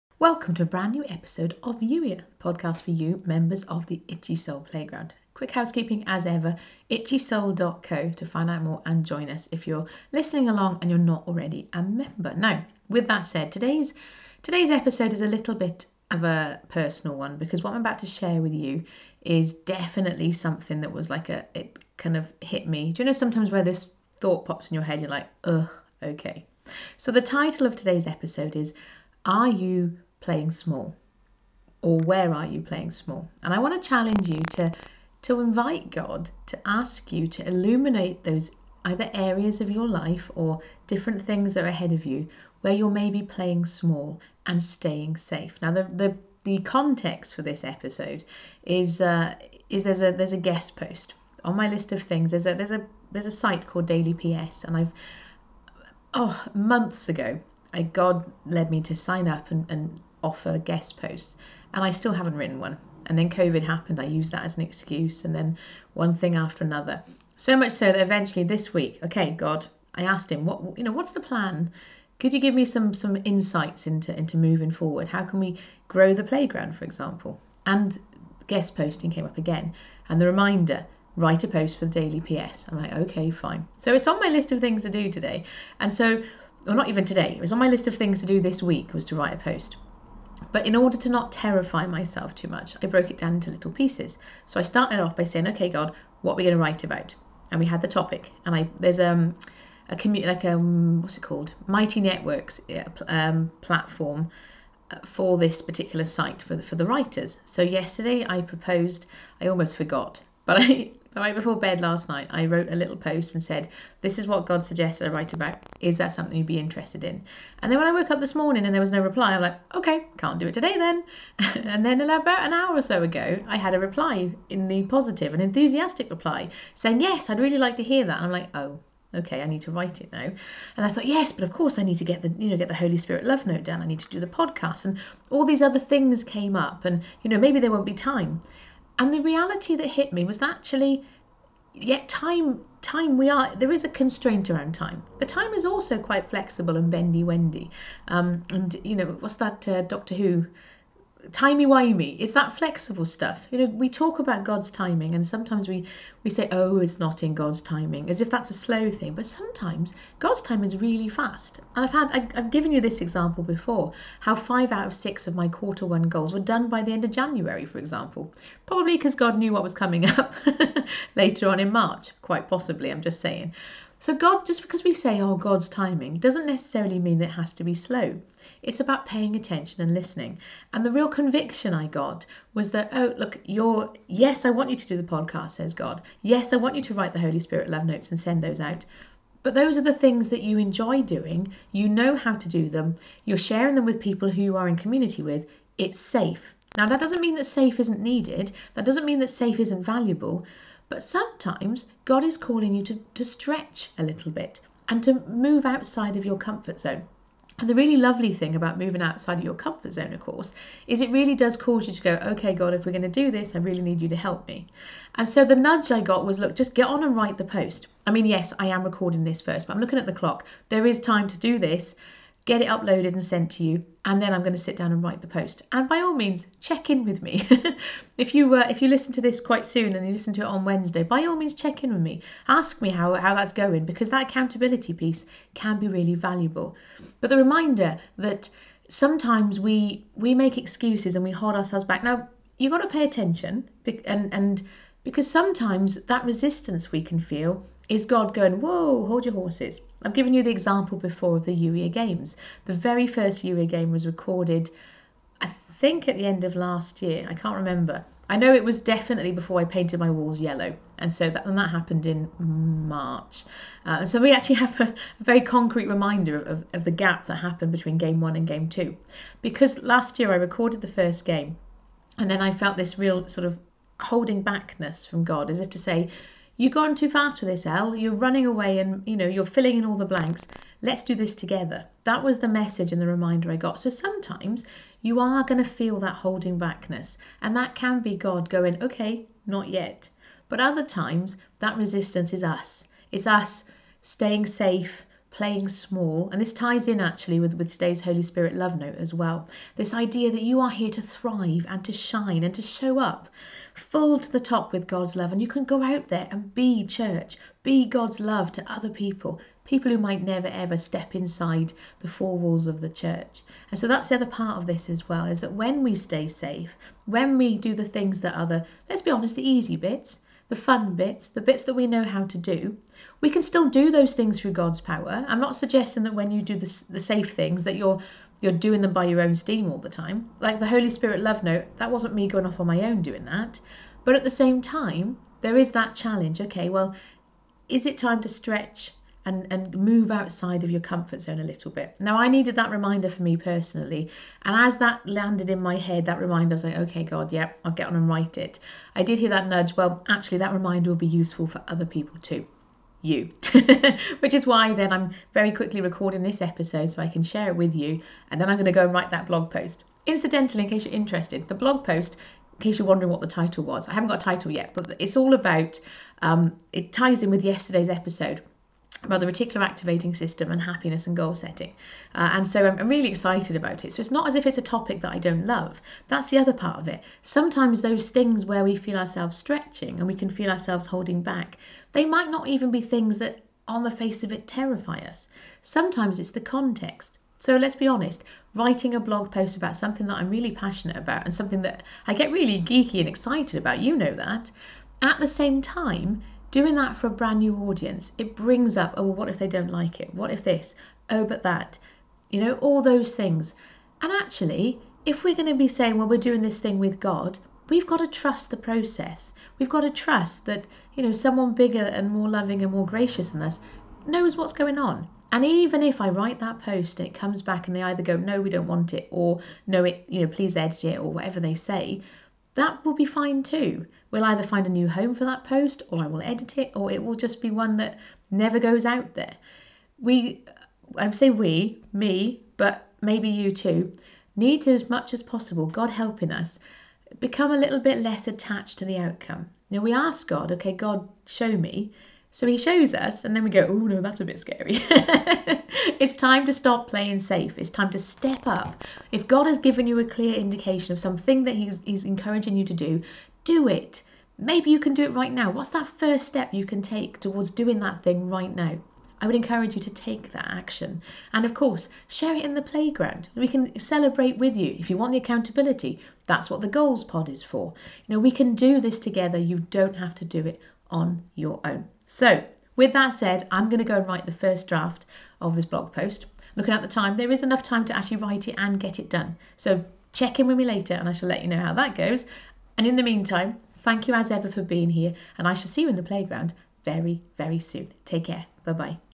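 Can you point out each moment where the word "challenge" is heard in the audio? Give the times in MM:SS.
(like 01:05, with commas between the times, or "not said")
00:33, 05:35.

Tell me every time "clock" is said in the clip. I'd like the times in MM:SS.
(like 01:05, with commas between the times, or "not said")
03:40.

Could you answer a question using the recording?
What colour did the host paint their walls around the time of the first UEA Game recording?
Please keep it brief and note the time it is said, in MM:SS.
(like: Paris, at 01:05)
Yellow, at 04:20.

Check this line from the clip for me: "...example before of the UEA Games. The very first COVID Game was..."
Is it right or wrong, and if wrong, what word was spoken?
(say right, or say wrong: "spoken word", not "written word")
wrong: "UEA", not "COVID".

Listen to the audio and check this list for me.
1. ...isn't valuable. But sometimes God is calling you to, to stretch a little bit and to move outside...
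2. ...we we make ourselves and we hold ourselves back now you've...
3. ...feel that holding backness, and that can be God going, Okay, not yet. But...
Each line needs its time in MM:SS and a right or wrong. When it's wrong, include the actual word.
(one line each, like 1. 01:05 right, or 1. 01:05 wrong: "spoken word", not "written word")
1. 03:19 right
2. 03:59 wrong: "excuses", not "ourselves"
3. 04:45 right.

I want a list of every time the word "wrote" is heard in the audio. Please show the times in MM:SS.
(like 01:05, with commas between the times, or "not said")
01:52.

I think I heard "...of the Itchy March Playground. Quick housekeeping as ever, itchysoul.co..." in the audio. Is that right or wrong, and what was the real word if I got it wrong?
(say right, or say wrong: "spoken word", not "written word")
wrong: "Soul", not "March".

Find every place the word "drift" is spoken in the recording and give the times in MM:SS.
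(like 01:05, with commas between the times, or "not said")
not said.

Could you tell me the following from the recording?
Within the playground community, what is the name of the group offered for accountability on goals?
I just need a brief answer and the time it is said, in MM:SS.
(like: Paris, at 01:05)
Goals pod, at 07:46.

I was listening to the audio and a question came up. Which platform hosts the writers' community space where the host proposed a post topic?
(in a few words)
Mighty Networks.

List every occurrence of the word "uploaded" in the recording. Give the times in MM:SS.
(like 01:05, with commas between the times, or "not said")
03:42.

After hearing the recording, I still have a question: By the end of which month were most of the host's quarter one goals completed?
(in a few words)
January.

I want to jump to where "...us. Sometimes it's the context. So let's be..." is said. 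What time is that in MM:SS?
06:24.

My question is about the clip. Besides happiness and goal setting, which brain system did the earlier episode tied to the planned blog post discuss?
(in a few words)
Reticular activating system.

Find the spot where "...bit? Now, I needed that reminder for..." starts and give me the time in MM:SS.
05:41.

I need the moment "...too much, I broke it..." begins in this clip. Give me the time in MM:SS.
01:32.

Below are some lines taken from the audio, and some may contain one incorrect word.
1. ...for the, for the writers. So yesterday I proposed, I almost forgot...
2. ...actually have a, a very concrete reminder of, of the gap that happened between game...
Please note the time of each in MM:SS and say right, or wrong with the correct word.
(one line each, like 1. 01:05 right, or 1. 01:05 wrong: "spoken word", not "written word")
1. 01:46 right
2. 04:24 right.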